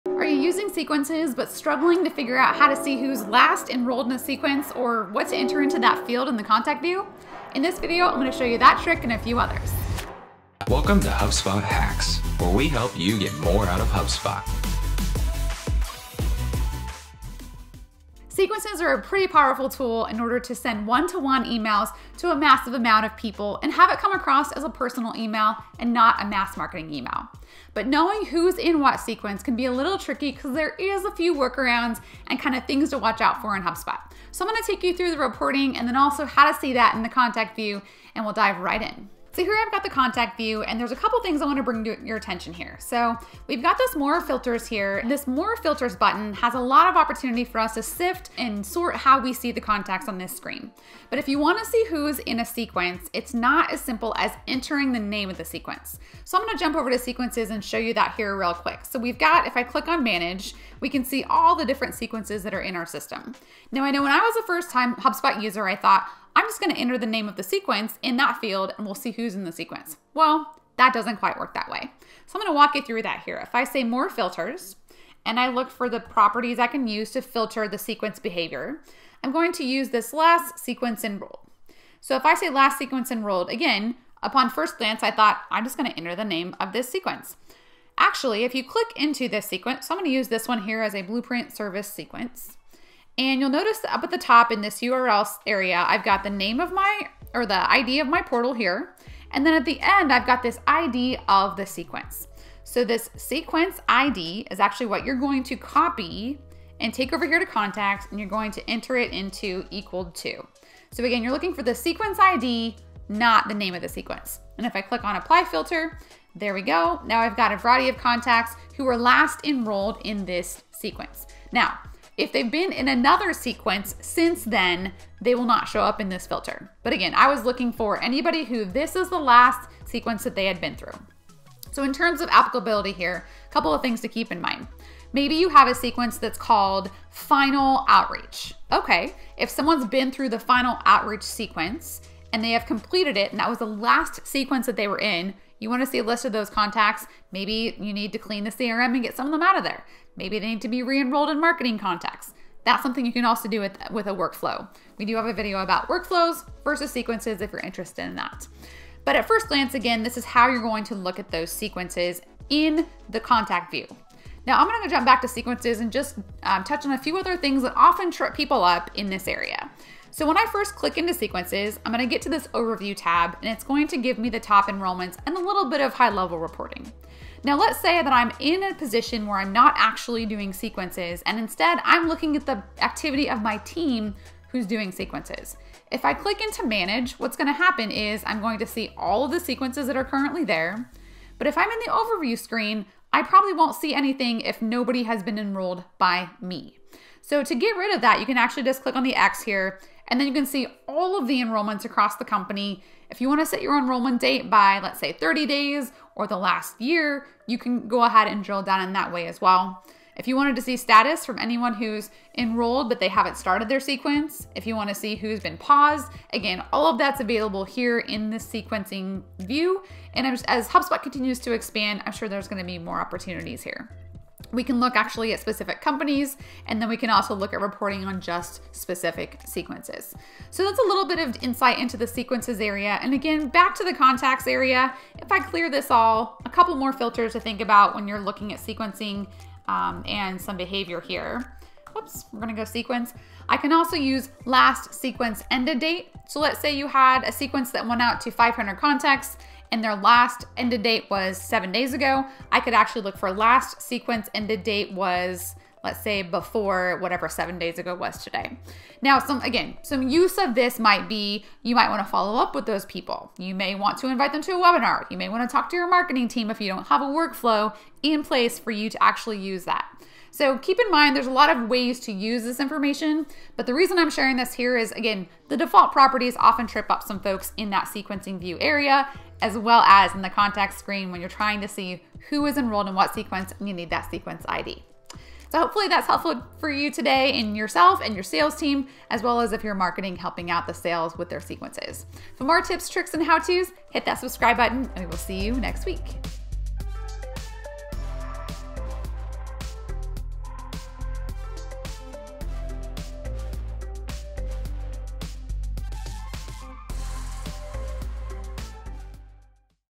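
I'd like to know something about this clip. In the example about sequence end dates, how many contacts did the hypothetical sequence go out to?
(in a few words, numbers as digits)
500.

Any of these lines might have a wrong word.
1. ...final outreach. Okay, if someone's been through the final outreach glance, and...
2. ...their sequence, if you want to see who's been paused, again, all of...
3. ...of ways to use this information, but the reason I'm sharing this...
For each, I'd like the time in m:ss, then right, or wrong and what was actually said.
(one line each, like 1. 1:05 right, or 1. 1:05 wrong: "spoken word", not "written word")
1. 2:17 wrong: "sequence", not "glance"
2. 3:33 right
3. 4:31 right.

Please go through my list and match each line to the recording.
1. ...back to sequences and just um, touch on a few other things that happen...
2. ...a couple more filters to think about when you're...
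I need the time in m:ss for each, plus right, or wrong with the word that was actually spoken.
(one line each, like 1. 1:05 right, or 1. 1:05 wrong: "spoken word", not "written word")
1. 2:45 wrong: "often", not "happen"
2. 3:56 right.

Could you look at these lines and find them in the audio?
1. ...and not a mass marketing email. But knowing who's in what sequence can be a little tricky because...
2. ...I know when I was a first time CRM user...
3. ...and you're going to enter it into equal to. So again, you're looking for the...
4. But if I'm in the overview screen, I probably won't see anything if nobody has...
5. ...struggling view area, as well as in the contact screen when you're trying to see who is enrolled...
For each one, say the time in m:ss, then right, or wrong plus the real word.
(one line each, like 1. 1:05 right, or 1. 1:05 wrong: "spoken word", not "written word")
1. 0:25 right
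2. 1:03 wrong: "HubSpot", not "CRM"
3. 1:48 right
4. 3:11 right
5. 4:37 wrong: "sequencing", not "struggling".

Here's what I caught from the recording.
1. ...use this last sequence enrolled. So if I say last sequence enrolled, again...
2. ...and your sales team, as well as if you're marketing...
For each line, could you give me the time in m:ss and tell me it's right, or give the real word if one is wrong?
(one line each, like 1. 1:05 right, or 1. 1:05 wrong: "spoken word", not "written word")
1. 1:19 right
2. 4:48 right.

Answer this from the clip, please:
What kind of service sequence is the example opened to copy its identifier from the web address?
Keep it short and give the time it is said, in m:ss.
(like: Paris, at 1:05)
blueprint, at 1:31.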